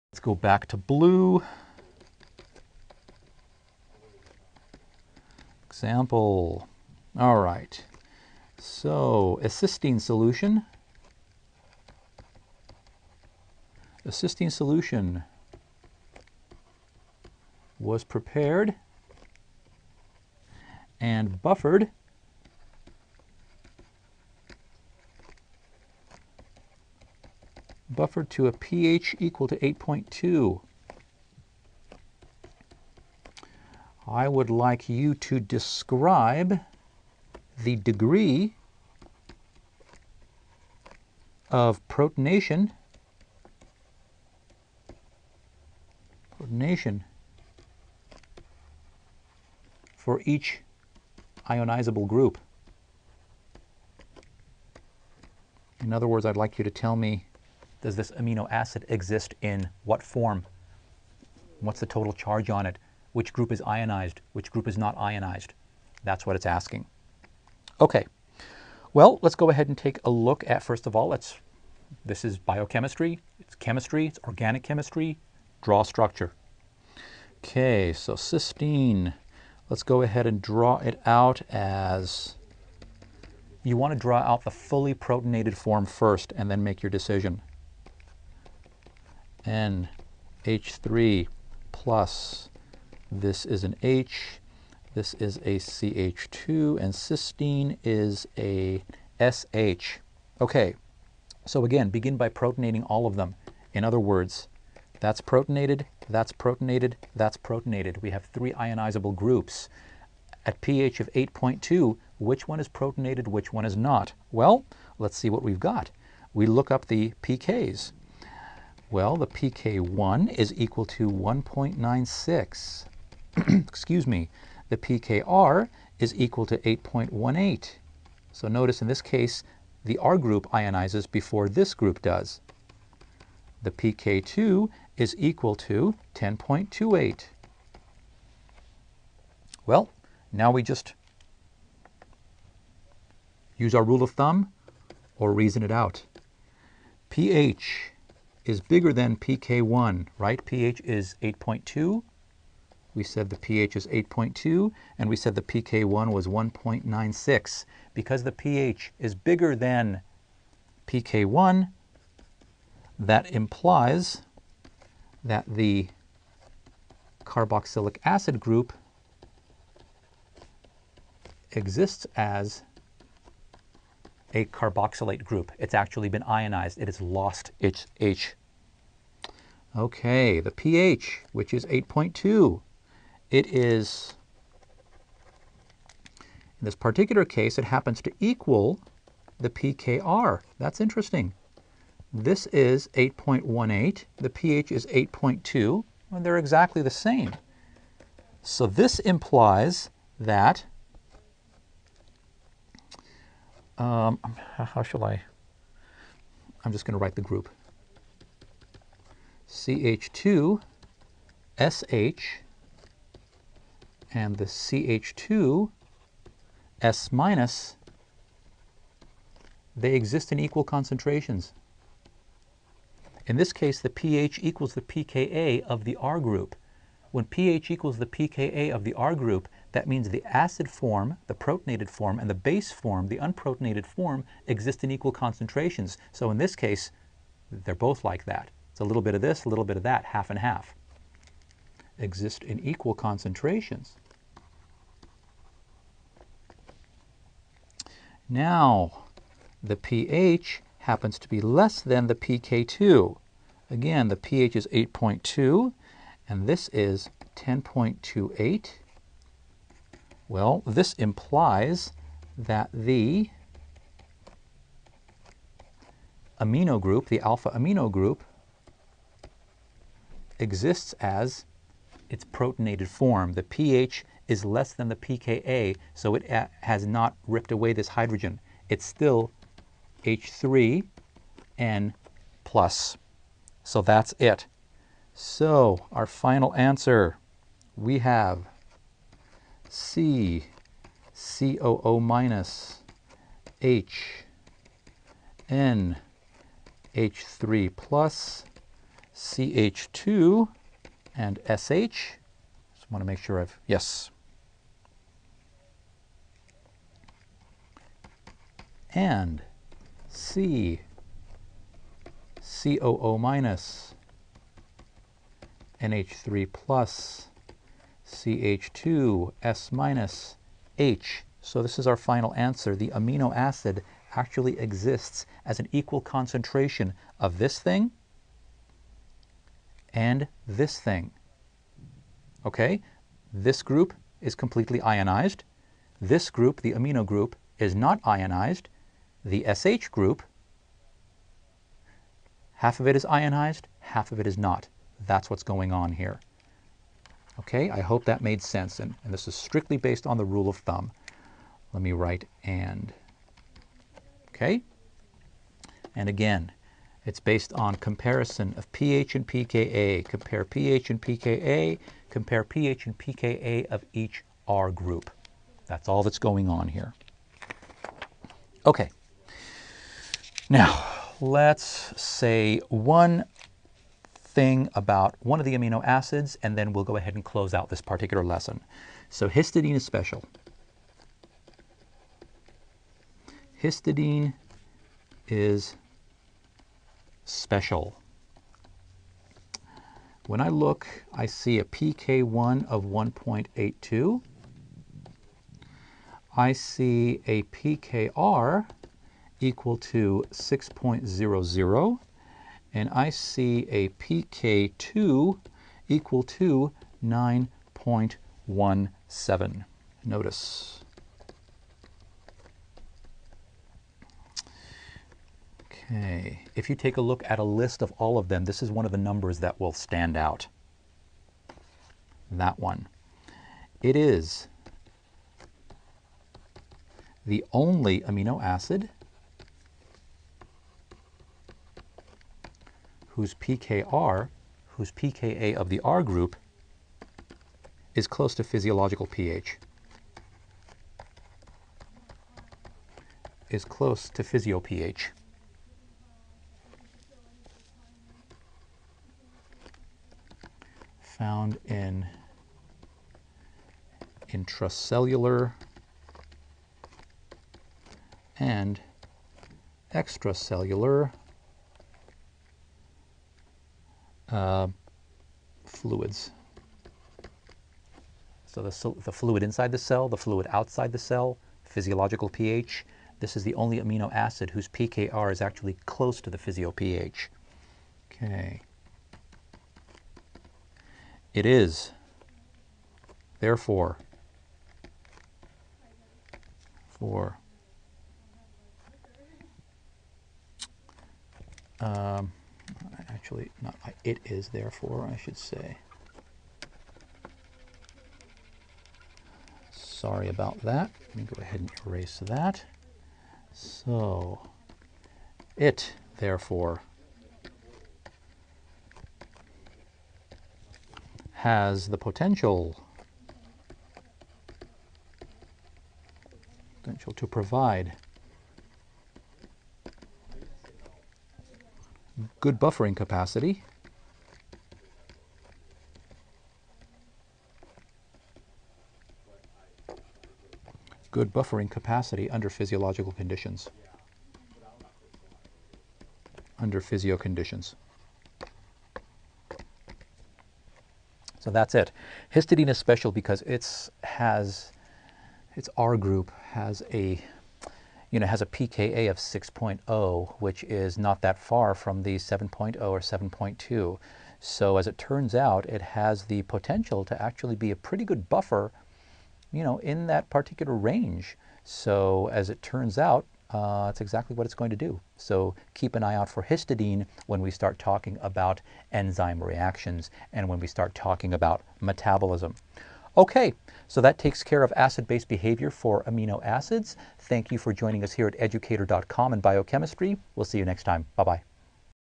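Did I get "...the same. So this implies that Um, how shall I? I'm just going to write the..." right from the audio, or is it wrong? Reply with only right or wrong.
right.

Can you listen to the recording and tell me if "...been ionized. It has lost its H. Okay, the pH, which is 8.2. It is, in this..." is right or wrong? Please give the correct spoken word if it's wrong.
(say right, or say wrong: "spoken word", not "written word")
right.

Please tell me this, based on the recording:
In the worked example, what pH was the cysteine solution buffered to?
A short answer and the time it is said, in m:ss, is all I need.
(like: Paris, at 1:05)
8.2, at 0:28.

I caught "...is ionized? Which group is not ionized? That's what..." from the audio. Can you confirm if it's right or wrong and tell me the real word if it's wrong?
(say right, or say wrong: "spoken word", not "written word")
right.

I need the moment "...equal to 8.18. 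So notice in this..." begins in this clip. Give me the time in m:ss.
2:06.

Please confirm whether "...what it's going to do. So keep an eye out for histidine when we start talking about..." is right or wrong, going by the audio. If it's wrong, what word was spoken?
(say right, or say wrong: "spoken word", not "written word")
right.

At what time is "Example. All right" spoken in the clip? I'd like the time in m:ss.
0:05.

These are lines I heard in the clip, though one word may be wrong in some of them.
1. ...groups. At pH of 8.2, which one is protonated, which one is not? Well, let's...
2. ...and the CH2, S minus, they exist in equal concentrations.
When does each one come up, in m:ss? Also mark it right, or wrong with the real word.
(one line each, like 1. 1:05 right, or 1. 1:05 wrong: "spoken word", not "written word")
1. 1:49 right
2. 3:34 right.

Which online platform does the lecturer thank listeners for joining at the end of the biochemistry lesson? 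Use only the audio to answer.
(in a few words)
educator.com.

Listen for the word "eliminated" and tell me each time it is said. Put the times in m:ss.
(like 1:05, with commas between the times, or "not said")
not said.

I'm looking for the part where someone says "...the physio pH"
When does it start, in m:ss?
7:56.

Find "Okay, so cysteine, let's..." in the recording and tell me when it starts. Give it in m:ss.
1:17.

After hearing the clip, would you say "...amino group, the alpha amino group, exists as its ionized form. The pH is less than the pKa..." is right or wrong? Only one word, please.
wrong.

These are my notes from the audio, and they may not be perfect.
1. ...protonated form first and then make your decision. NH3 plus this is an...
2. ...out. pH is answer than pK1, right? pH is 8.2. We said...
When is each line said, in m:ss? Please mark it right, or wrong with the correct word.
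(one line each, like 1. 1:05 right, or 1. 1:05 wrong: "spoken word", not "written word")
1. 1:24 right
2. 2:25 wrong: "bigger", not "answer".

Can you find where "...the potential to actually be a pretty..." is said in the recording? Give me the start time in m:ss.
9:16.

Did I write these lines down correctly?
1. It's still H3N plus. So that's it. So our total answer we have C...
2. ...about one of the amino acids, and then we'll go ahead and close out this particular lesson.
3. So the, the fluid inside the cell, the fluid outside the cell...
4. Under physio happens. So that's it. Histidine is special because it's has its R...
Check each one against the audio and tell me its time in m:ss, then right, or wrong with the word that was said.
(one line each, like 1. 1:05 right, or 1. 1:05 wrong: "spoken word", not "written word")
1. 4:38 wrong: "final", not "total"
2. 6:14 right
3. 7:48 right
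4. 8:56 wrong: "conditions", not "happens".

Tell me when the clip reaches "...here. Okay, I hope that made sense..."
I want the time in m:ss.
5:45.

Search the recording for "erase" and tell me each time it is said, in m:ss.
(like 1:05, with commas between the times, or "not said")
8:21.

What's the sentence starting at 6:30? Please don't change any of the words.
When I look, I see a pK1 of 1.82.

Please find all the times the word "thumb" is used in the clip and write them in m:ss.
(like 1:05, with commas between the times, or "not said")
2:24, 5:50.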